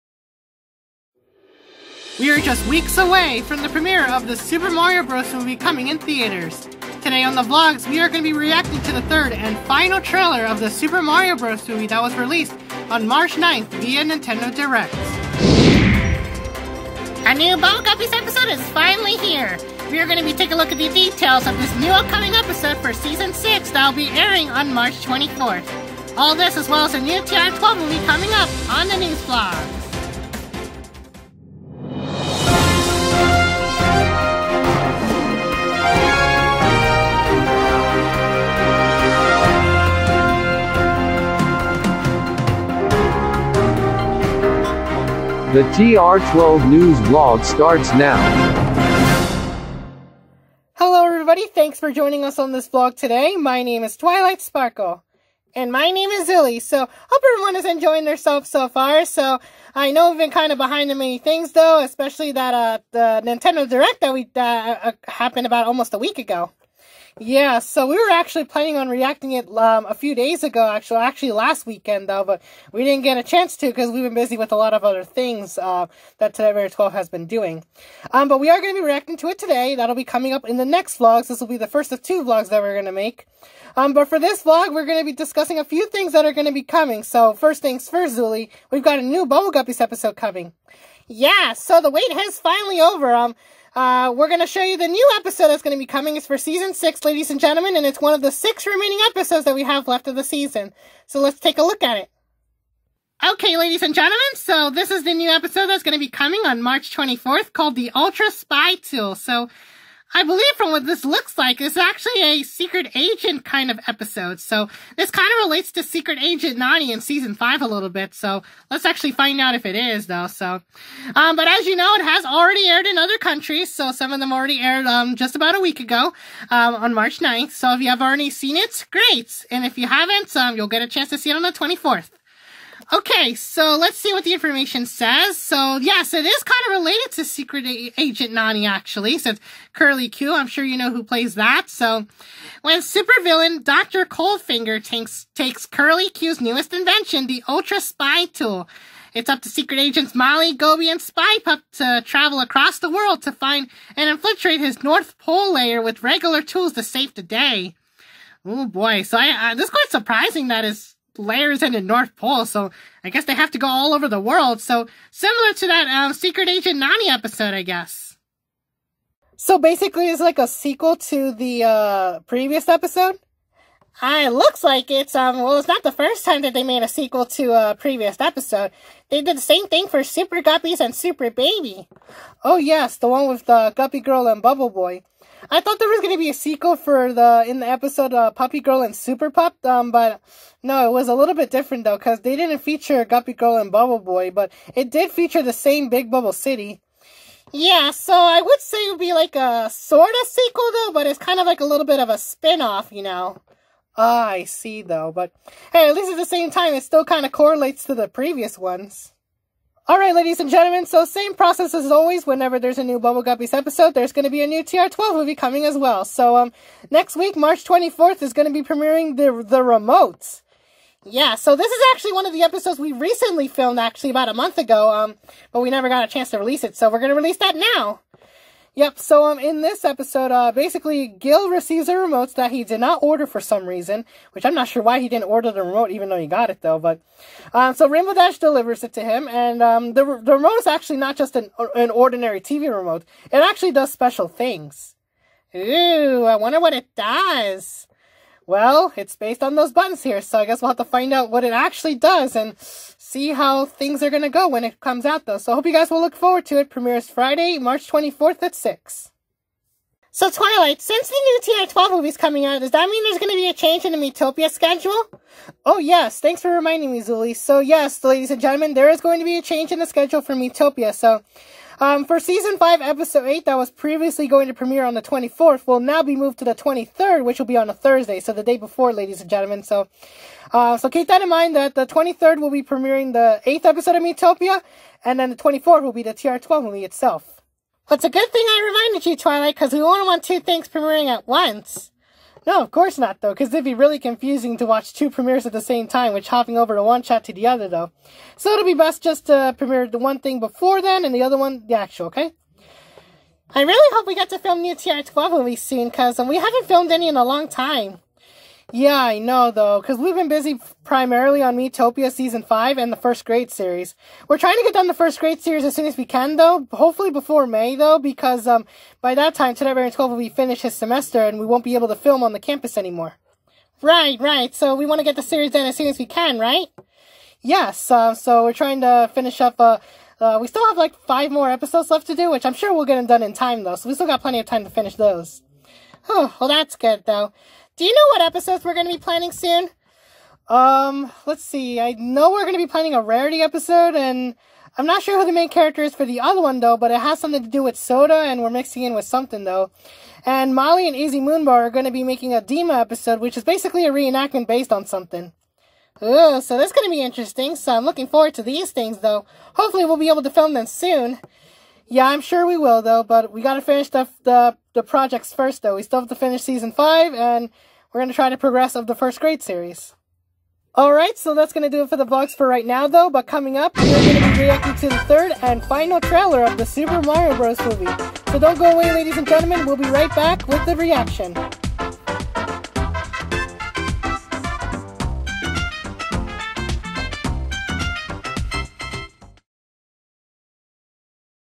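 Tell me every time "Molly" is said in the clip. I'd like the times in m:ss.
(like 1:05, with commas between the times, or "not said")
2:30, 5:50.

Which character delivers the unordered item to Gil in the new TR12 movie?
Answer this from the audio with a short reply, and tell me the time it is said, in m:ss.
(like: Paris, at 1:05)
Rainbow Dash, at 3:57.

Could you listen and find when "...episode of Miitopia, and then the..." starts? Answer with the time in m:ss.
4:43.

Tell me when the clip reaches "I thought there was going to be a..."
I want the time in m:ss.
3:05.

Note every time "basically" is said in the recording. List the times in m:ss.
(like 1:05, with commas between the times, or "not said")
2:49, 3:50, 5:53.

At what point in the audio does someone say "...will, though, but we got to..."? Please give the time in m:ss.
6:02.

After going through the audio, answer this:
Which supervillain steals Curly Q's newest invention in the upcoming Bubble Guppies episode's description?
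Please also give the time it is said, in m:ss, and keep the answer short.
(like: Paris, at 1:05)
Dr. Coldfinger, at 2:23.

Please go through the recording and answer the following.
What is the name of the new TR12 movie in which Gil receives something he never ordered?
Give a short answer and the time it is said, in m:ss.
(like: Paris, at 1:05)
The Remotes, at 3:39.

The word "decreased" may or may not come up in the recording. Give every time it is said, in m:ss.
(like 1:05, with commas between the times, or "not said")
not said.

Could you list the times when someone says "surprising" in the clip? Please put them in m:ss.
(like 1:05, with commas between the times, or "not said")
2:39.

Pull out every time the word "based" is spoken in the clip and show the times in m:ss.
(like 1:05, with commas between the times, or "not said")
4:09, 5:54.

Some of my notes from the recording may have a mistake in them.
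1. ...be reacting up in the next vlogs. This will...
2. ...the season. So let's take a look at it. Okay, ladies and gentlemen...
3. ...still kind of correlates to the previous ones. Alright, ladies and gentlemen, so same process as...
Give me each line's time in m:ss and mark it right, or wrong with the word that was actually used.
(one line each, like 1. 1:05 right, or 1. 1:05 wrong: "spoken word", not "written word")
1. 1:19 wrong: "coming", not "reacting"
2. 1:40 right
3. 3:26 right.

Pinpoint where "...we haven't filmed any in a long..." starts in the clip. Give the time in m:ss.
5:06.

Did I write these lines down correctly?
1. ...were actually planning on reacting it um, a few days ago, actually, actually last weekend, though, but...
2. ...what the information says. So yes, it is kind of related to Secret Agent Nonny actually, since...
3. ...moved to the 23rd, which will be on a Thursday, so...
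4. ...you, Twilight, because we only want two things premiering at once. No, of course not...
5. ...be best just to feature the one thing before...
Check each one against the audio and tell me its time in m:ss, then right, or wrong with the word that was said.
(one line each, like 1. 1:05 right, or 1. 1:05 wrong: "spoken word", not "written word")
1. 1:07 right
2. 2:14 right
3. 4:36 right
4. 4:49 right
5. 4:58 wrong: "premiere", not "feature".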